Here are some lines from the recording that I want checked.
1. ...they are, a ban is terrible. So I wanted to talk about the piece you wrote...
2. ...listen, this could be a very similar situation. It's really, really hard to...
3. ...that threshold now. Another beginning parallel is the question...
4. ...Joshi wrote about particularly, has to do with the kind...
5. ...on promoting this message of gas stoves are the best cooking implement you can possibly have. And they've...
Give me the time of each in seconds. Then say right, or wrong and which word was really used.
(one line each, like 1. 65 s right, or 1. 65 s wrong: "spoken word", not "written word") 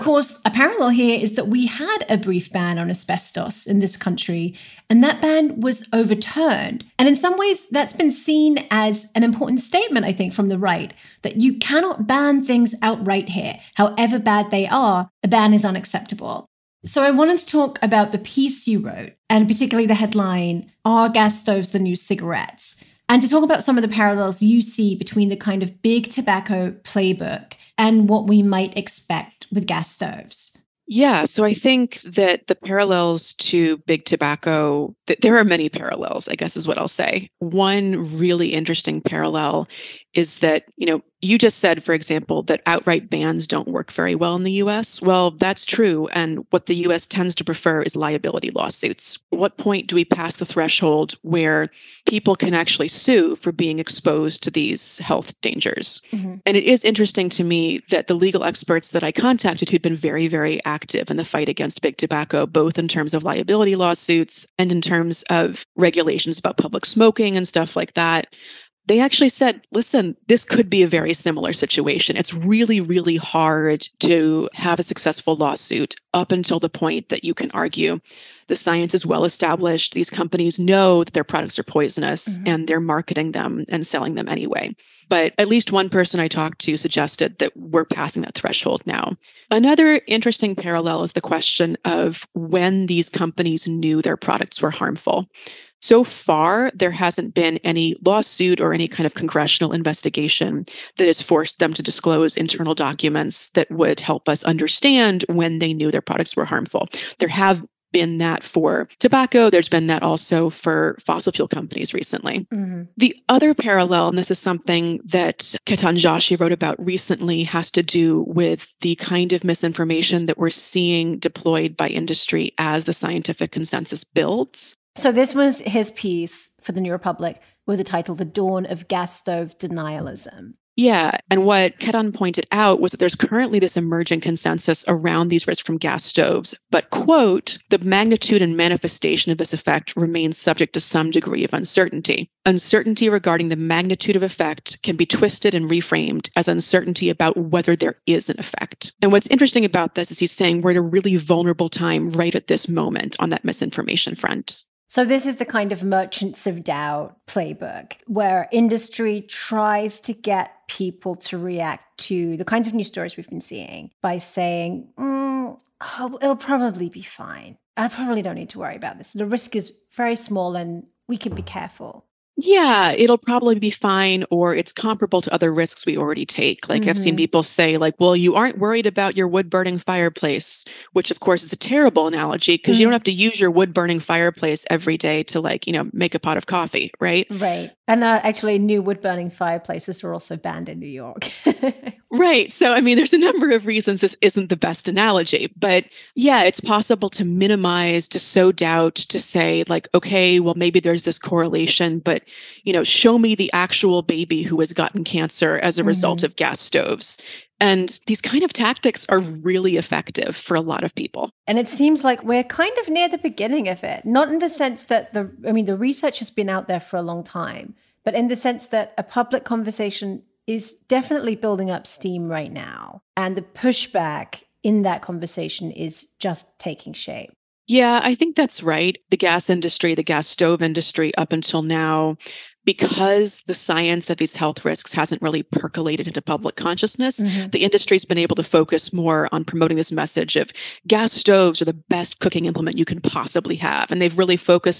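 1. 14 s wrong: "unacceptable", not "terrible"
2. 69 s right
3. 88 s wrong: "interesting", not "beginning"
4. 115 s wrong: "recently", not "particularly"
5. 239 s right.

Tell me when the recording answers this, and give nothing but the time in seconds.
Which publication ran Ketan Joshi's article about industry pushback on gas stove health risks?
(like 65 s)
126 s.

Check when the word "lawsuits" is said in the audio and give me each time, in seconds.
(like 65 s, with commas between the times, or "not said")
48 s, 63 s, 75 s, 98 s.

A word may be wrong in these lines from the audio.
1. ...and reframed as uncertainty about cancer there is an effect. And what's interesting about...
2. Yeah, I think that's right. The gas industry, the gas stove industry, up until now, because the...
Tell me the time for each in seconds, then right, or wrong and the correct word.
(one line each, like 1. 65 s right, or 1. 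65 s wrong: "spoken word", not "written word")
1. 145 s wrong: "whether", not "cancer"
2. 227 s right.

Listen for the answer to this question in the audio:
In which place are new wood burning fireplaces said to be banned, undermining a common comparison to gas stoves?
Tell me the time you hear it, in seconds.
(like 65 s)
190 s.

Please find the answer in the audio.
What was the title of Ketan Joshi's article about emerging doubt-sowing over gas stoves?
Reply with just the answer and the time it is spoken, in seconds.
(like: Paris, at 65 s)
The Dawn of Gas Stove Denialism, at 128 s.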